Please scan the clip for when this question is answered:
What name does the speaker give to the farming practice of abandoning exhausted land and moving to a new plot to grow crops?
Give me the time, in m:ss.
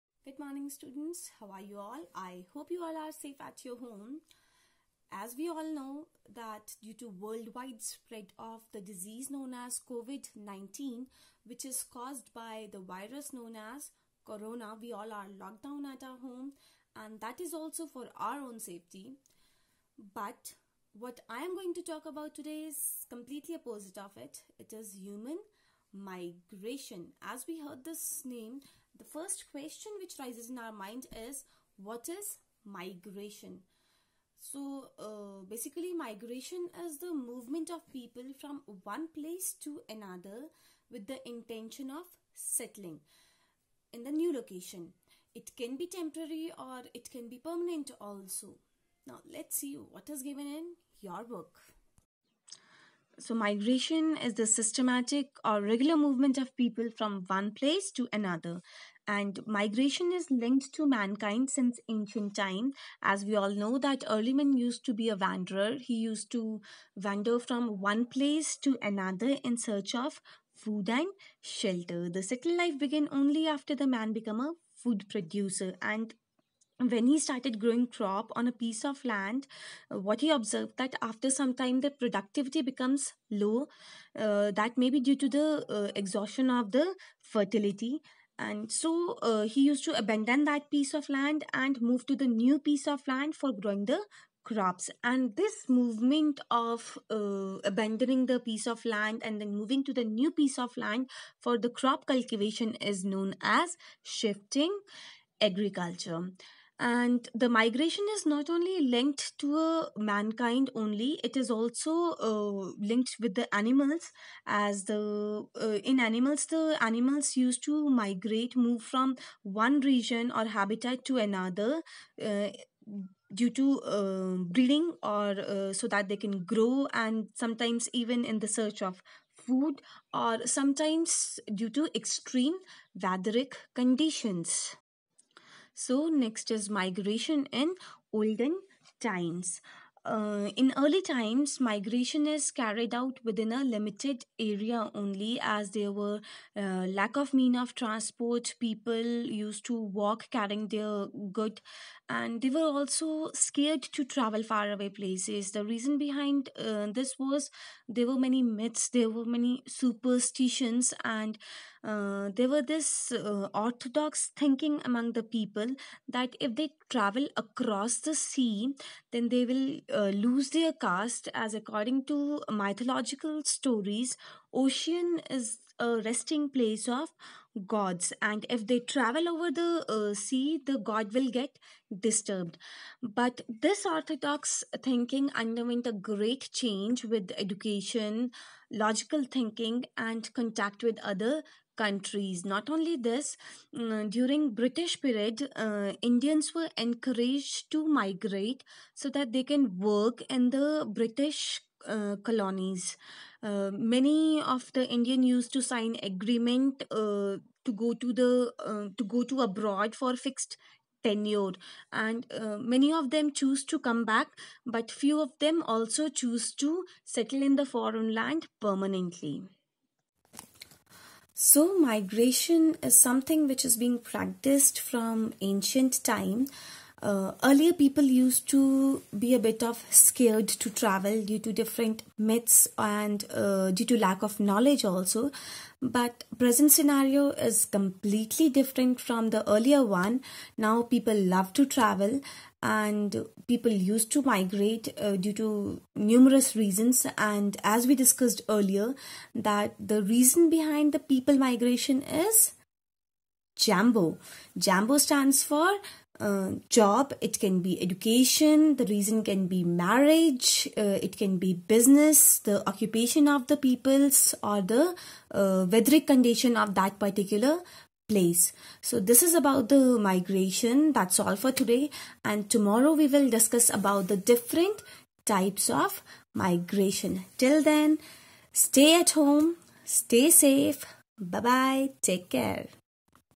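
1:44.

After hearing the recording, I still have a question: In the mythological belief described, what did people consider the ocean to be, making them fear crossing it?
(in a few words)
Resting place of gods.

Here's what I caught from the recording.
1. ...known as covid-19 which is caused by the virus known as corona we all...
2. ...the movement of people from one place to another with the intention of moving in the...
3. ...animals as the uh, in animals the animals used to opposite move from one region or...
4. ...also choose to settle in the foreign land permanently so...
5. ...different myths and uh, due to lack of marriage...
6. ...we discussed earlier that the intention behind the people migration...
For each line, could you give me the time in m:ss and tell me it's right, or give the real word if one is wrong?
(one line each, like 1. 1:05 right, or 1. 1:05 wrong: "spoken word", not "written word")
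1. 0:09 right
2. 0:36 wrong: "settling", not "moving"
3. 1:53 wrong: "migrate", not "opposite"
4. 3:35 right
5. 3:51 wrong: "knowledge", not "marriage"
6. 4:07 wrong: "reason", not "intention".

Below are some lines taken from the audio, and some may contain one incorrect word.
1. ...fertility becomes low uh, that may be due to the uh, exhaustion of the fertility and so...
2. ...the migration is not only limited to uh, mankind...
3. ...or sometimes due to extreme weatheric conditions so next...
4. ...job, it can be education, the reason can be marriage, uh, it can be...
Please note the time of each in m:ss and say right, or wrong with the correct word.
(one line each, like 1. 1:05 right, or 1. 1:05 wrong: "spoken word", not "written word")
1. 1:21 wrong: "productivity", not "fertility"
2. 1:47 wrong: "linked", not "limited"
3. 2:10 right
4. 4:16 right.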